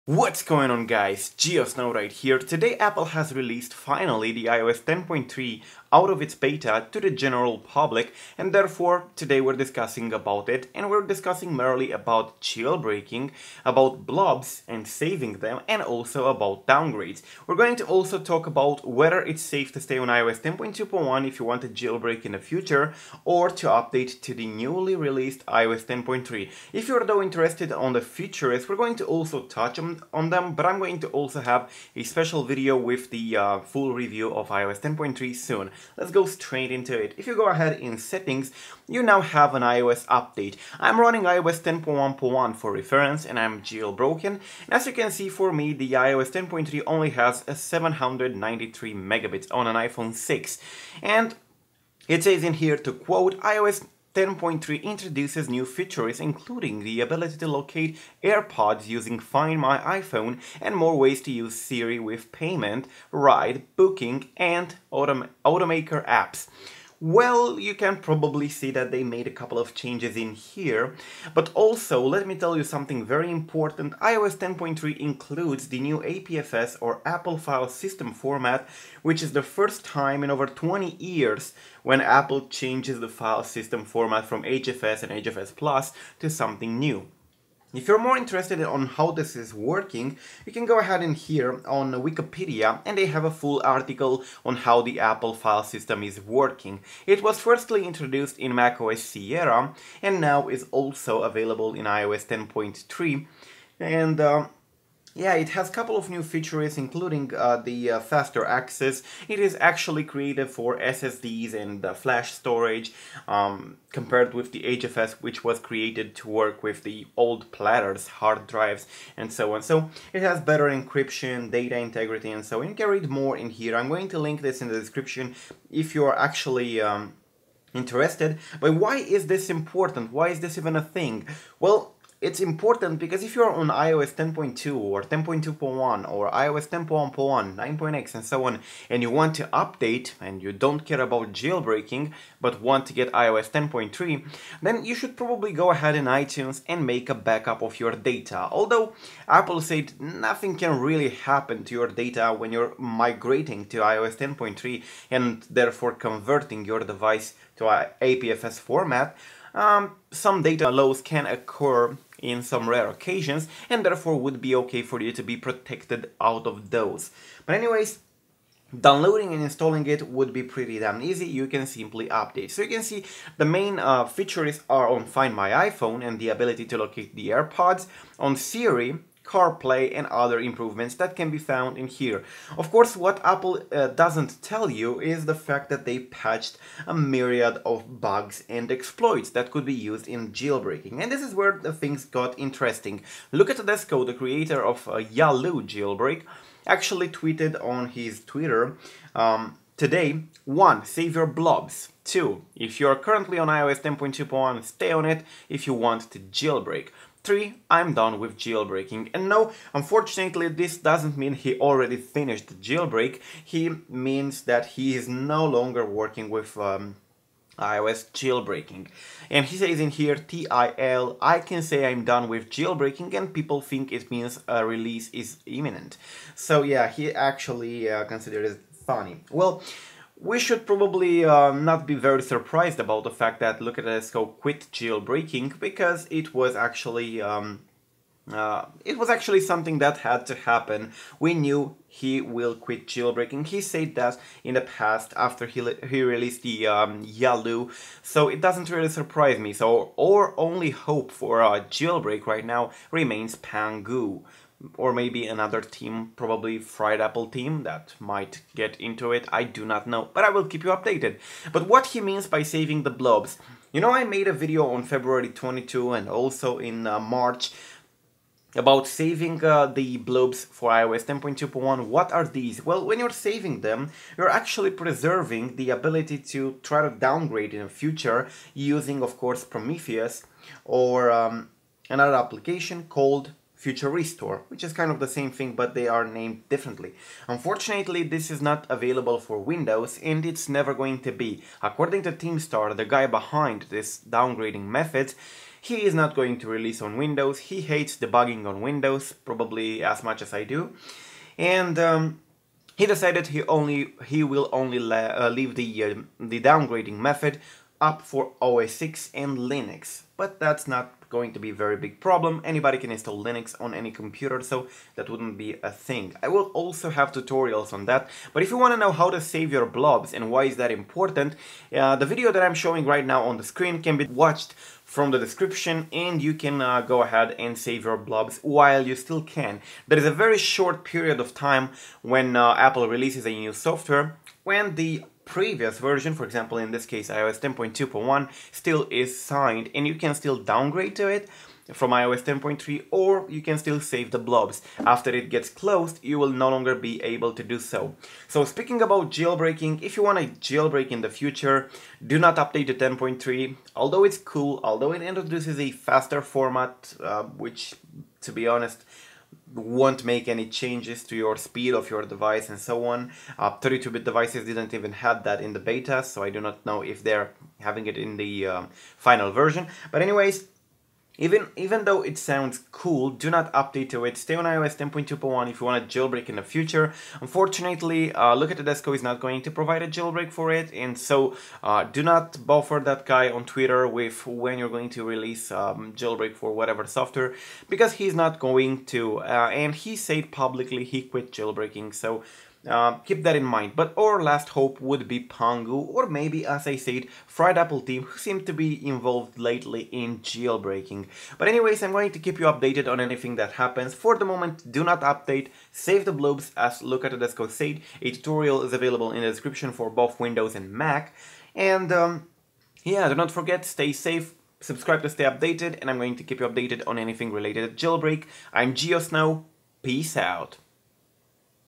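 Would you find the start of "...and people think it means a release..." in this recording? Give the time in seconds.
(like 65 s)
223 s.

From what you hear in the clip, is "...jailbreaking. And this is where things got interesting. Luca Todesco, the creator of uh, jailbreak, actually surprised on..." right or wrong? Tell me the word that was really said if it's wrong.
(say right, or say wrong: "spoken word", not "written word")
wrong: "tweeted", not "surprised".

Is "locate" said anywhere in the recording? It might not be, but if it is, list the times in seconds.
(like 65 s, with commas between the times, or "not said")
57 s, 176 s.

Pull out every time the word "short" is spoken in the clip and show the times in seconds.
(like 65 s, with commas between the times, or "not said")
330 s.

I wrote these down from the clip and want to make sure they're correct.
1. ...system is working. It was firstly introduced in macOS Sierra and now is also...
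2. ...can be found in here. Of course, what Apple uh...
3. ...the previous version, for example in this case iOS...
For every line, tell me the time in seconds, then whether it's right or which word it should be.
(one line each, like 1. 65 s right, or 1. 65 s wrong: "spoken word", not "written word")
1. 95 s right
2. 181 s right
3. 334 s right.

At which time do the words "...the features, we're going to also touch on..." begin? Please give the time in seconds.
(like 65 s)
27 s.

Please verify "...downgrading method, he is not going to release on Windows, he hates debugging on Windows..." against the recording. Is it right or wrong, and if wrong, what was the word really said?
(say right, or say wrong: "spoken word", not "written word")
right.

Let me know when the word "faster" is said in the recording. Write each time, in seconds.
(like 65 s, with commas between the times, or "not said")
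107 s, 355 s.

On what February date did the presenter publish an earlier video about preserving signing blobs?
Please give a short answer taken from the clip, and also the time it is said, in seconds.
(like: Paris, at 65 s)
February 22, at 264 s.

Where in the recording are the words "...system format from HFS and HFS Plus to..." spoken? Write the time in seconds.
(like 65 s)
83 s.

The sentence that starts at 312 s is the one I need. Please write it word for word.
Anybody can install Linux on any computer, so that wouldn't be a thing.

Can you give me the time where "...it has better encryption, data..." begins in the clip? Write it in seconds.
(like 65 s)
120 s.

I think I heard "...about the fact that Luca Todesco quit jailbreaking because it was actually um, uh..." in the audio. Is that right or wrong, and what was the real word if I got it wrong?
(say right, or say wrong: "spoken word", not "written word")
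right.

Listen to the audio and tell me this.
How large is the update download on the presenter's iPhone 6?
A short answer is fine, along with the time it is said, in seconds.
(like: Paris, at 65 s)
793 megabits, at 47 s.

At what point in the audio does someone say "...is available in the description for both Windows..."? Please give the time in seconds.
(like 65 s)
408 s.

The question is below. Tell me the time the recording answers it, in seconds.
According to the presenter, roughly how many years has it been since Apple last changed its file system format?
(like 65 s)
80 s.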